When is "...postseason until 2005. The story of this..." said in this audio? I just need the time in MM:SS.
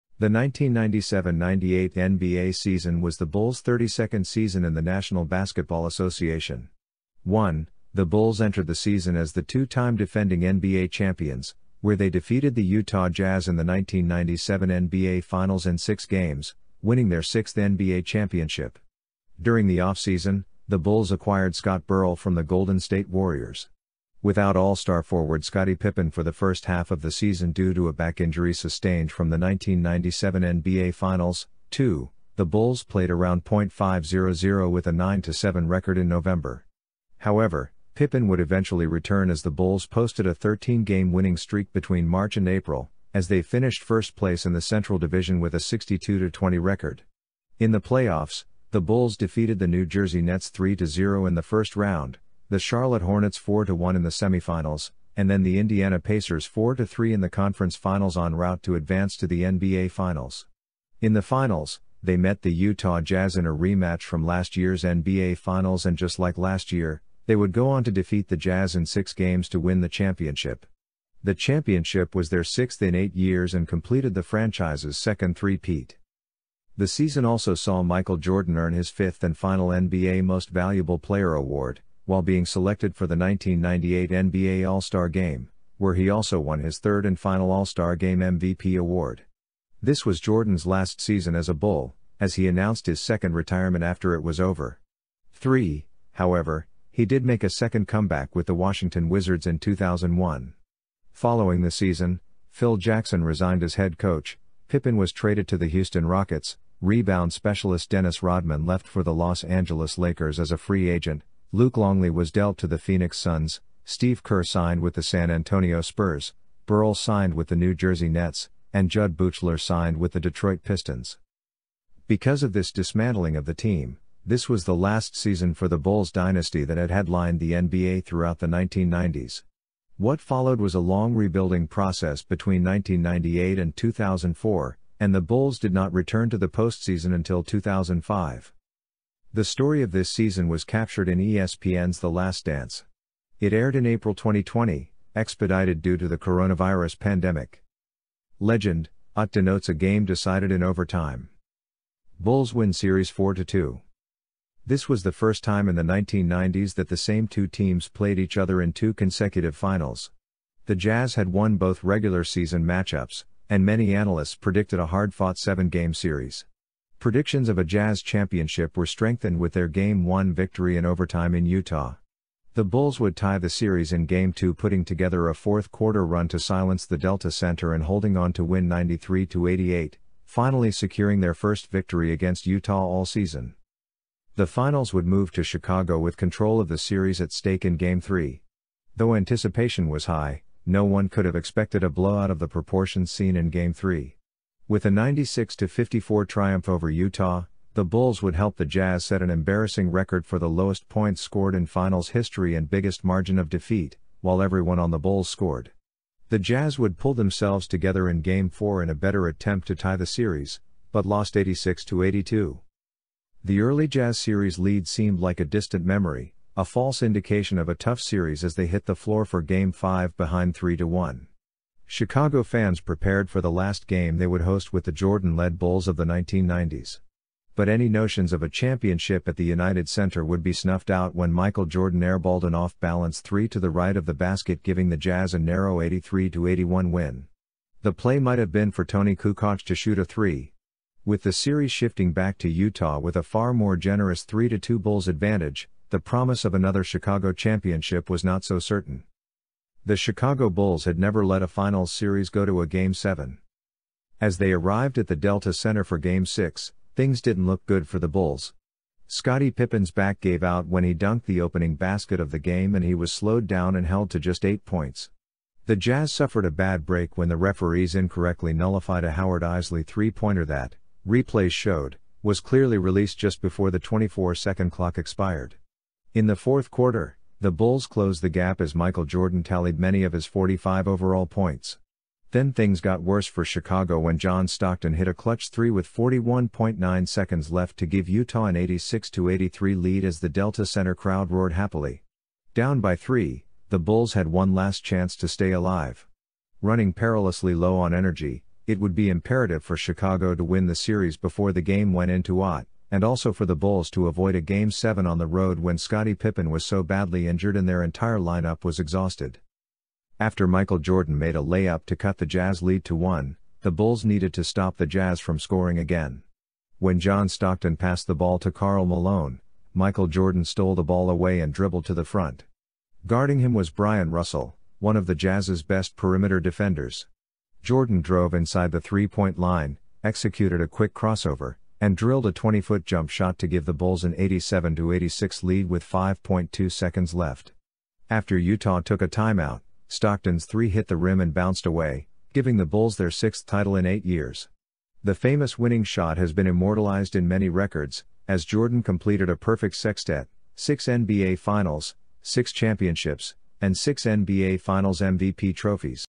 02:16.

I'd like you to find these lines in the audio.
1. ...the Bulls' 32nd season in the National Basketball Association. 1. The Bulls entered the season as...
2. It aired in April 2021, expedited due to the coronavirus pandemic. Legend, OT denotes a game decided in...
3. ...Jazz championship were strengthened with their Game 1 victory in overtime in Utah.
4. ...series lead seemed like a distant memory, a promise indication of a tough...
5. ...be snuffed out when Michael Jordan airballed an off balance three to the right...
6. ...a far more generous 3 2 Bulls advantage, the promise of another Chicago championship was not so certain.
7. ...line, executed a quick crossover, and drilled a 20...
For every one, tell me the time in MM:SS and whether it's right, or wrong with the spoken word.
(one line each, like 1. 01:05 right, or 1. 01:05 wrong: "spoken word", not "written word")
1. 00:03 right
2. 02:23 wrong: "2020", not "2021"
3. 02:47 right
4. 03:34 wrong: "false", not "promise"
5. 03:50 right
6. 04:03 right
7. 05:29 right.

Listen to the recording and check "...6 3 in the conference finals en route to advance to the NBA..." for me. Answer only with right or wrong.
wrong.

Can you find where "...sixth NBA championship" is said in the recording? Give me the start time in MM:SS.
00:17.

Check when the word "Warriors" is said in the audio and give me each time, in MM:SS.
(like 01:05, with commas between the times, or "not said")
00:23.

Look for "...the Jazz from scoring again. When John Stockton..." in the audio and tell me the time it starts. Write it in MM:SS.
05:14.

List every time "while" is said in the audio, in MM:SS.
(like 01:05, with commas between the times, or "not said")
01:22, 03:24.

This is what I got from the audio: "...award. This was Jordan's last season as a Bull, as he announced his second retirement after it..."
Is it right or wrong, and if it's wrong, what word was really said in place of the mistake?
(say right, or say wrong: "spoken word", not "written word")
right.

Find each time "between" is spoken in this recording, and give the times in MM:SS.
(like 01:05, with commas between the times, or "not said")
00:41, 02:12.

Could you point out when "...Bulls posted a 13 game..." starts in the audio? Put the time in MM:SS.
00:39.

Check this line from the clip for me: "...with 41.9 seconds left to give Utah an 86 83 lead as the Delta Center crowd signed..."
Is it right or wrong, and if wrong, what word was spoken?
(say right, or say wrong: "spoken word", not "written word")
wrong: "roared", not "signed".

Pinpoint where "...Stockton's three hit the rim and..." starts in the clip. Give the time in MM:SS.
05:39.